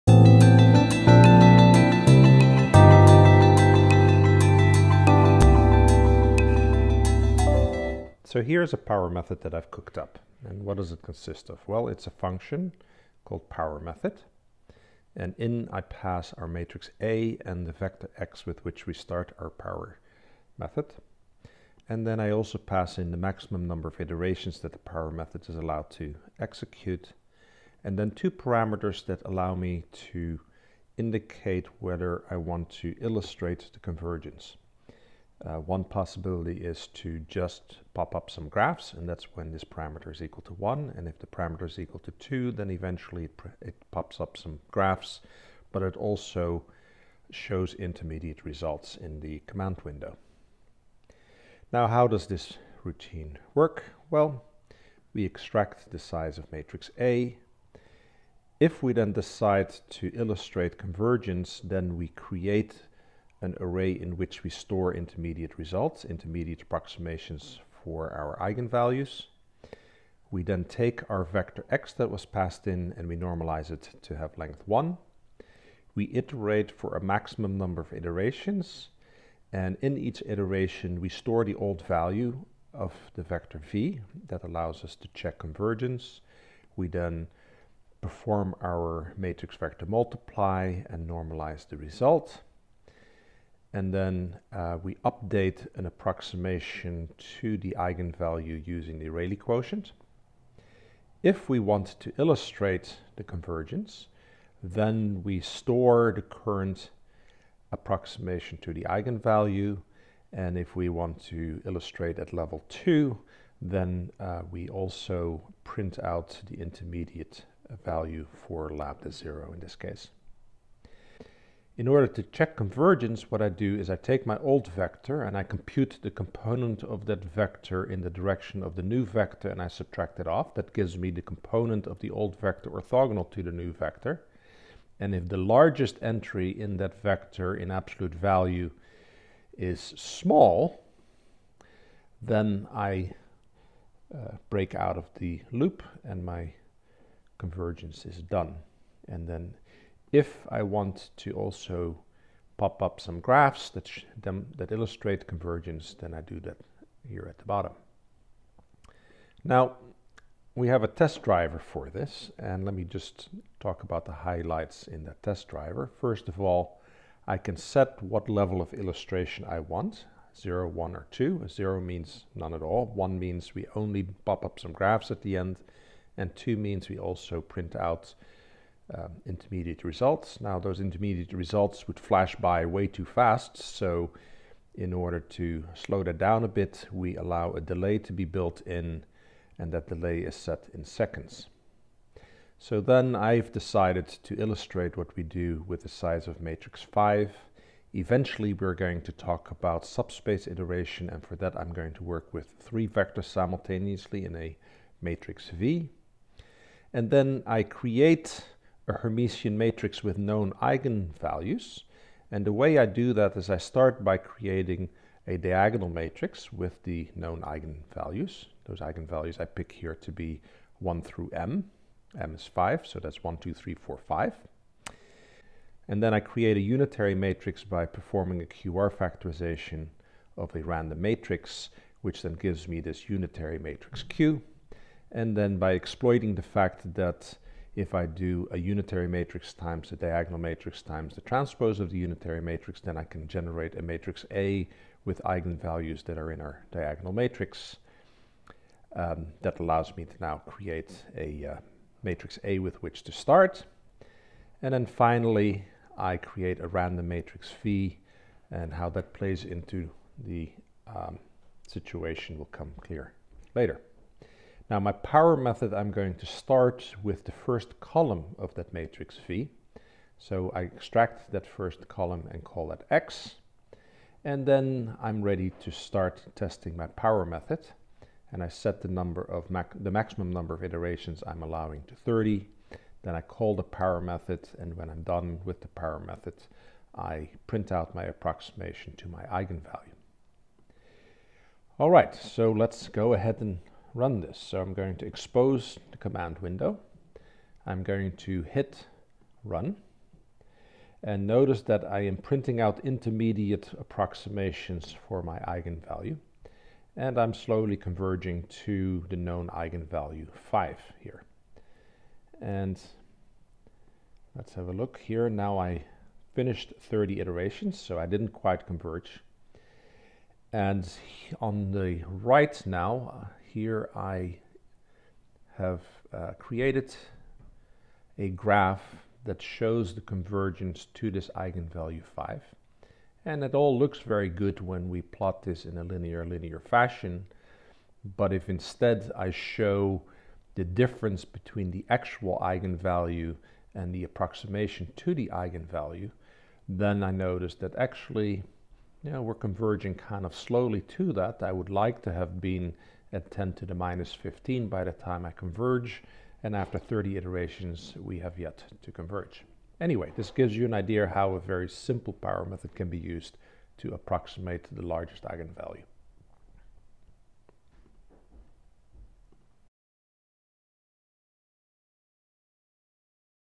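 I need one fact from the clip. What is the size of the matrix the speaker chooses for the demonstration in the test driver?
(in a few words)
5.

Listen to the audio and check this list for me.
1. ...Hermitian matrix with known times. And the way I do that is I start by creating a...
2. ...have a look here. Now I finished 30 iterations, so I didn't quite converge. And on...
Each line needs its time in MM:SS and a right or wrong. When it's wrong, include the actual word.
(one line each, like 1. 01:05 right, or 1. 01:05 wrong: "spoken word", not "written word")
1. 03:28 wrong: "eigenvalues", not "times"
2. 05:14 right.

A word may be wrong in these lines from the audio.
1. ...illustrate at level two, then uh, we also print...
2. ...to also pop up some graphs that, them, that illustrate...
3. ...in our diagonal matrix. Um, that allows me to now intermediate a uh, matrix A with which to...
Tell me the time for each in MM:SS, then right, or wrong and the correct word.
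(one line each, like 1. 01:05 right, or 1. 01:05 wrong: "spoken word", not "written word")
1. 01:51 right
2. 02:31 right
3. 04:06 wrong: "create", not "intermediate".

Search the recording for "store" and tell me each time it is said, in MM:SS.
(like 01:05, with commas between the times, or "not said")
01:04, 01:21, 01:45.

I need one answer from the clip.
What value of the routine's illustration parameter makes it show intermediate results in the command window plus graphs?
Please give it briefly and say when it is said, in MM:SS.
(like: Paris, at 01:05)
2, at 00:41.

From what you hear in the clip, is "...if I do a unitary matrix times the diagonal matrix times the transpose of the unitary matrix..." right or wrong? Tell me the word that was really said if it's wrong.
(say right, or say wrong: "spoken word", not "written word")
right.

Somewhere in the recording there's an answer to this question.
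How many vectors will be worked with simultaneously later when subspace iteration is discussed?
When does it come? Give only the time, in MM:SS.
03:22.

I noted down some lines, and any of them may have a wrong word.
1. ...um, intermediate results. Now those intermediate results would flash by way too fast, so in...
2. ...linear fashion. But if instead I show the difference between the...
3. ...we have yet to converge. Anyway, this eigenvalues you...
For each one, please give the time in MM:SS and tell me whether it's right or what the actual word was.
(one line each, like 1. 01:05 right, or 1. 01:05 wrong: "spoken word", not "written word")
1. 02:58 right
2. 05:36 right
3. 05:58 wrong: "gives", not "eigenvalues".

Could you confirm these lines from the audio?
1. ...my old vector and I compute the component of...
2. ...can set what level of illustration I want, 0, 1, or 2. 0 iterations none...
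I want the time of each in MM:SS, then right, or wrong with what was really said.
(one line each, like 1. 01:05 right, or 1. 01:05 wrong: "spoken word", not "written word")
1. 02:04 right
2. 02:47 wrong: "means", not "iterations".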